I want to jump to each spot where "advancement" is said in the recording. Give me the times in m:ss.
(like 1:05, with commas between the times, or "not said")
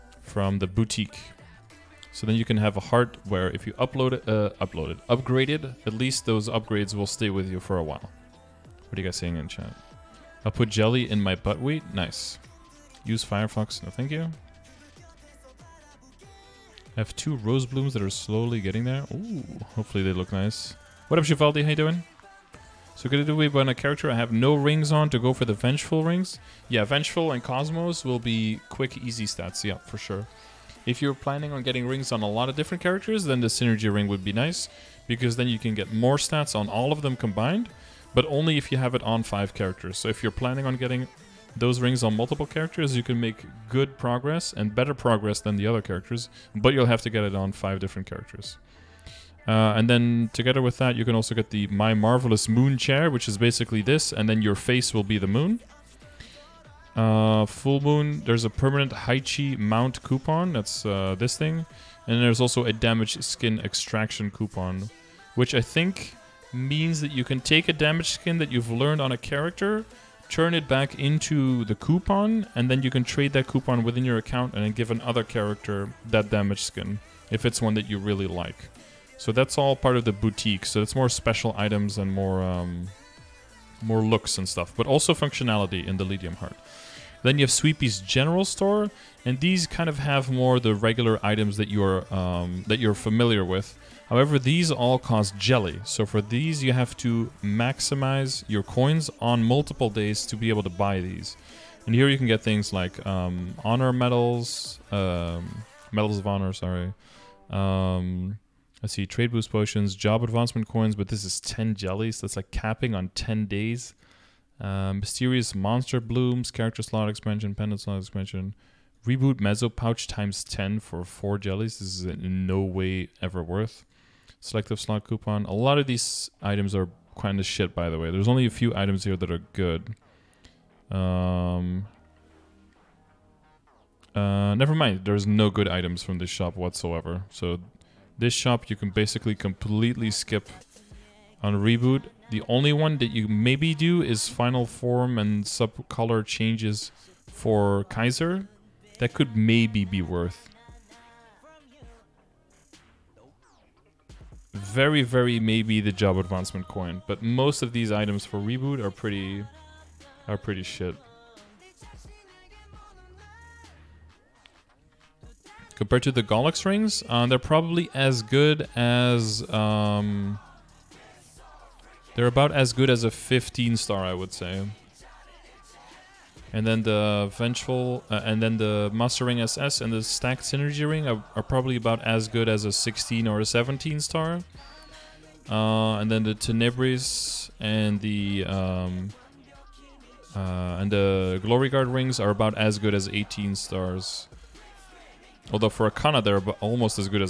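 1:50, 2:36.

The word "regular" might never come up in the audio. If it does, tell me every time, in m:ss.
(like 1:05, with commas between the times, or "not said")
1:30.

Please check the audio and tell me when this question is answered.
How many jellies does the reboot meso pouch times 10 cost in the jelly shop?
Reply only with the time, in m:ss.
2:01.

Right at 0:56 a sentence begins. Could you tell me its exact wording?
Uh, full Moon, there's a permanent Haichi mount coupon, that's uh, this thing.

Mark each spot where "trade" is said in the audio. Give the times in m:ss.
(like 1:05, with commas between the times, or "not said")
1:13, 1:49.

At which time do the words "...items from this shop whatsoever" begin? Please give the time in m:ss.
2:15.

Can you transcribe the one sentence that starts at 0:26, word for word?
Yeah, Vengeful and Cosmos will be quick, easy stats, yeah, for sure.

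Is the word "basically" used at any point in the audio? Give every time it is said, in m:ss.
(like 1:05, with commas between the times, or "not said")
0:53, 2:18.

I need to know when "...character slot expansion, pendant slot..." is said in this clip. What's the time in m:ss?
1:56.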